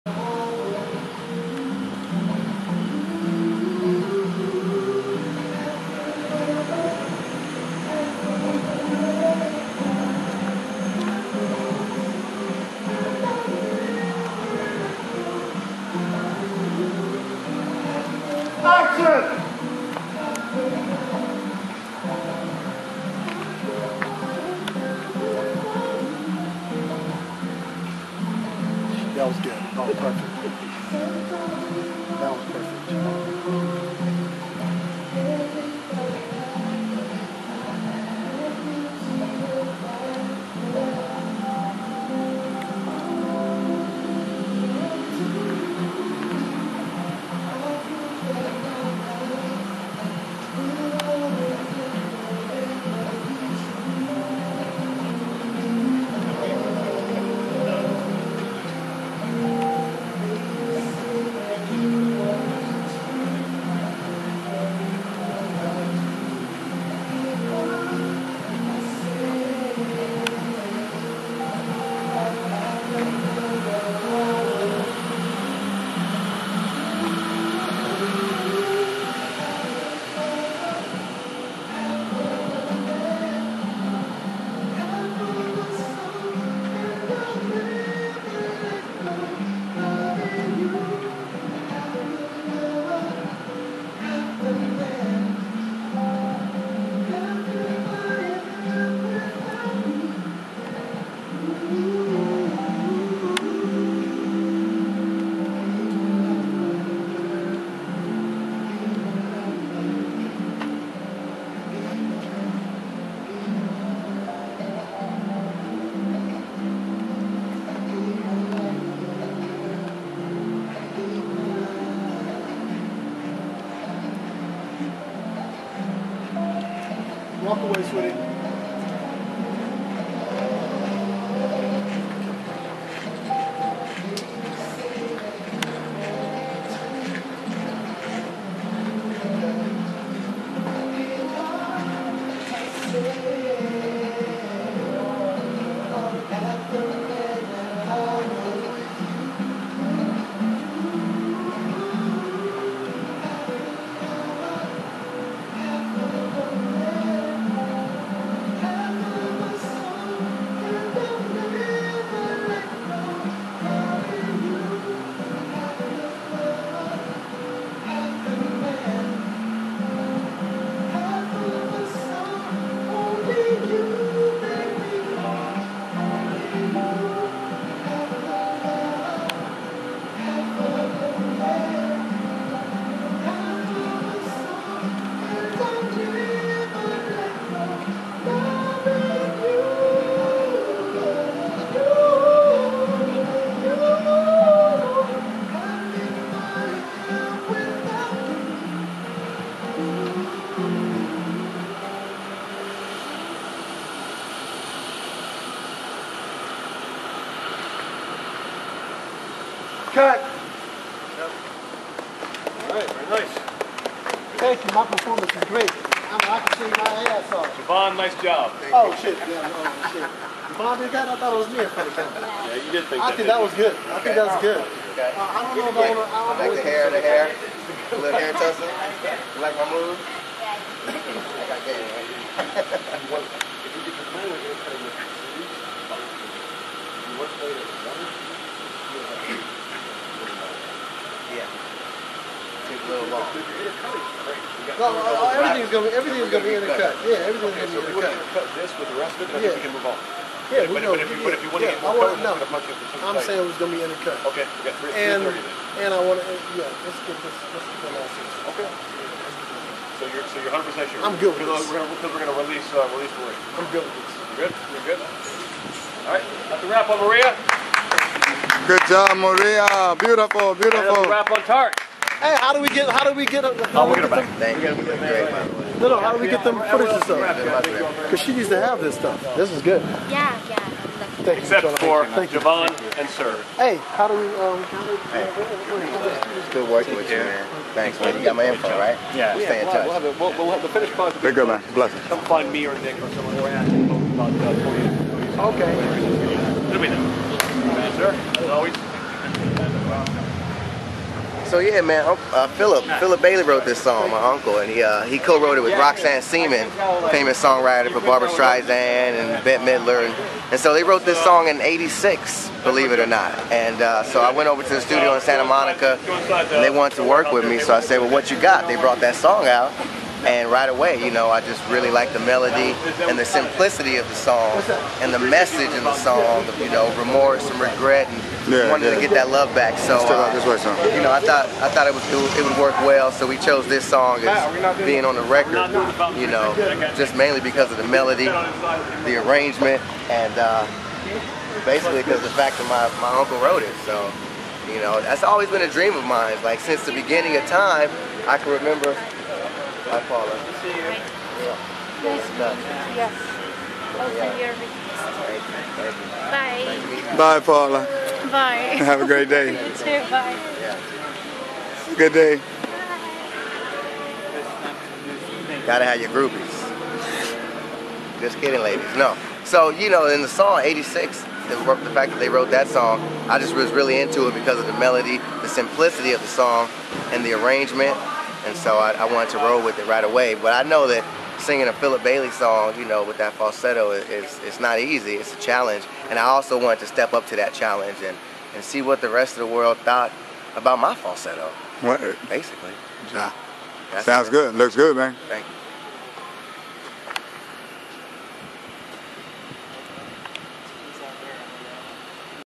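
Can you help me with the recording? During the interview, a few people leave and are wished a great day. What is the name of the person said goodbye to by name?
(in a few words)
Paula.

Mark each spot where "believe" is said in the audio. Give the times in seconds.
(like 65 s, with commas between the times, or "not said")
312 s.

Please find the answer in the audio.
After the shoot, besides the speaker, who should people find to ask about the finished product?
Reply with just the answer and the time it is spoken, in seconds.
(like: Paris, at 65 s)
Nick, at 292 s.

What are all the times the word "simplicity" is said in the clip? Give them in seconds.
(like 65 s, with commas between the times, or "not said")
323 s, 375 s.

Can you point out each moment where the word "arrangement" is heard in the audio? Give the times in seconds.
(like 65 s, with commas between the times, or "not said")
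339 s, 377 s.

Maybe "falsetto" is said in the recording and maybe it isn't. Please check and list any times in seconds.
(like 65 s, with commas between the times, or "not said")
383 s, 390 s.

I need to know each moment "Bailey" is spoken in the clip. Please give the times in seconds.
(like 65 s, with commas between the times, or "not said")
303 s, 382 s.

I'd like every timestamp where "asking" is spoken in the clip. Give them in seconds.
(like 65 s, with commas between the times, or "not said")
293 s.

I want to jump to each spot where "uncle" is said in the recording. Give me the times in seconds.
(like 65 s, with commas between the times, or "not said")
304 s, 343 s.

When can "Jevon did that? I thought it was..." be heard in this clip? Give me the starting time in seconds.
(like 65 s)
220 s.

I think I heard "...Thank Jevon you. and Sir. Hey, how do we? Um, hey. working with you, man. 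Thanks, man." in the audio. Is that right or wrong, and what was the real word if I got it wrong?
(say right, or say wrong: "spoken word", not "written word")
right.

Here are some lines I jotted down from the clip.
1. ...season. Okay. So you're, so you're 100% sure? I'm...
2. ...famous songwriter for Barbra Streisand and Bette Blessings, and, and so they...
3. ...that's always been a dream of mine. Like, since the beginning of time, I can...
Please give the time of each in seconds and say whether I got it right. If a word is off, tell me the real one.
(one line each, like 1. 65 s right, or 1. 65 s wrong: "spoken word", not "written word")
1. 258 s right
2. 307 s wrong: "Midler", not "Blessings"
3. 345 s right.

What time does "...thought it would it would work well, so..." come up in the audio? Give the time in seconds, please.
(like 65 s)
331 s.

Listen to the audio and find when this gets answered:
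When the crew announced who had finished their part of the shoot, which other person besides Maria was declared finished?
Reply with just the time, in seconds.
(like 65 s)
271 s.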